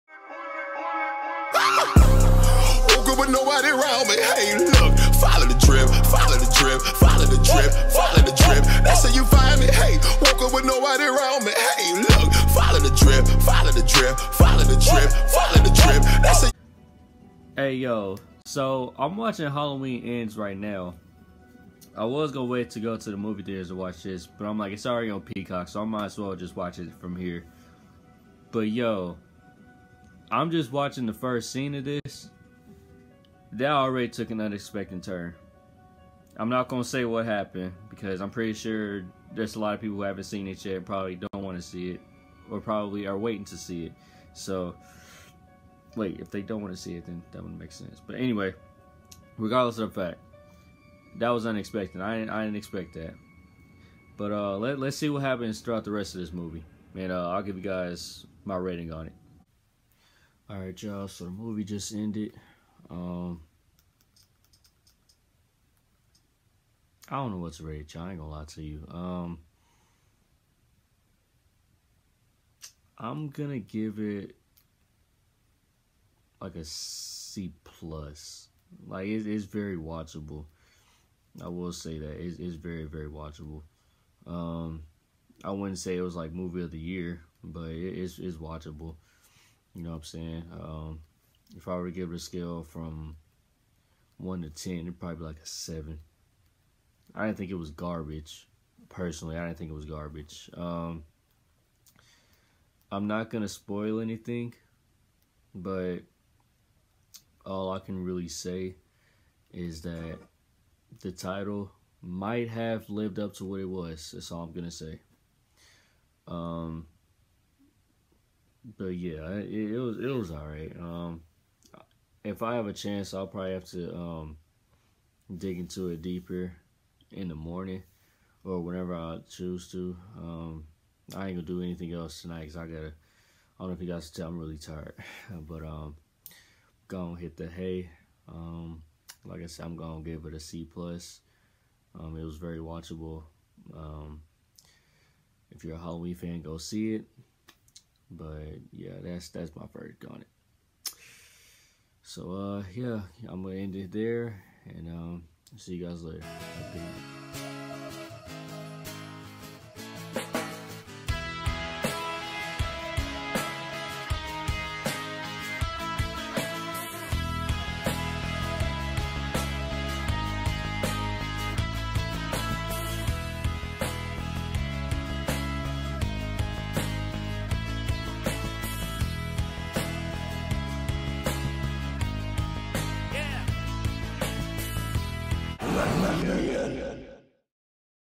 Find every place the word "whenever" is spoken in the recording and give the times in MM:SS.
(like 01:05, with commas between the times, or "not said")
02:08.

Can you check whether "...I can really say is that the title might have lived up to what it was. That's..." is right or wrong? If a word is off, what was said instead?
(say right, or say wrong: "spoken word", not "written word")
right.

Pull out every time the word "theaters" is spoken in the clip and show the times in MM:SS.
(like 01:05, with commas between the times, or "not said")
00:23.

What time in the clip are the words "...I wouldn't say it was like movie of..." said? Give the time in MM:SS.
01:25.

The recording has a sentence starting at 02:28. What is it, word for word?
But yeah, that's that's my verdict on it.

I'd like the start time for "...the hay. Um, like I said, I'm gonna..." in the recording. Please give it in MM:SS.
02:17.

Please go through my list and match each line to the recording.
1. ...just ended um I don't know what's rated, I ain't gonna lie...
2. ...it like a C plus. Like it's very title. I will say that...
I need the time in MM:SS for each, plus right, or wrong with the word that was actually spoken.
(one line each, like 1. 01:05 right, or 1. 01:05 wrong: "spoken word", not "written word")
1. 01:01 right
2. 01:13 wrong: "watchable", not "title".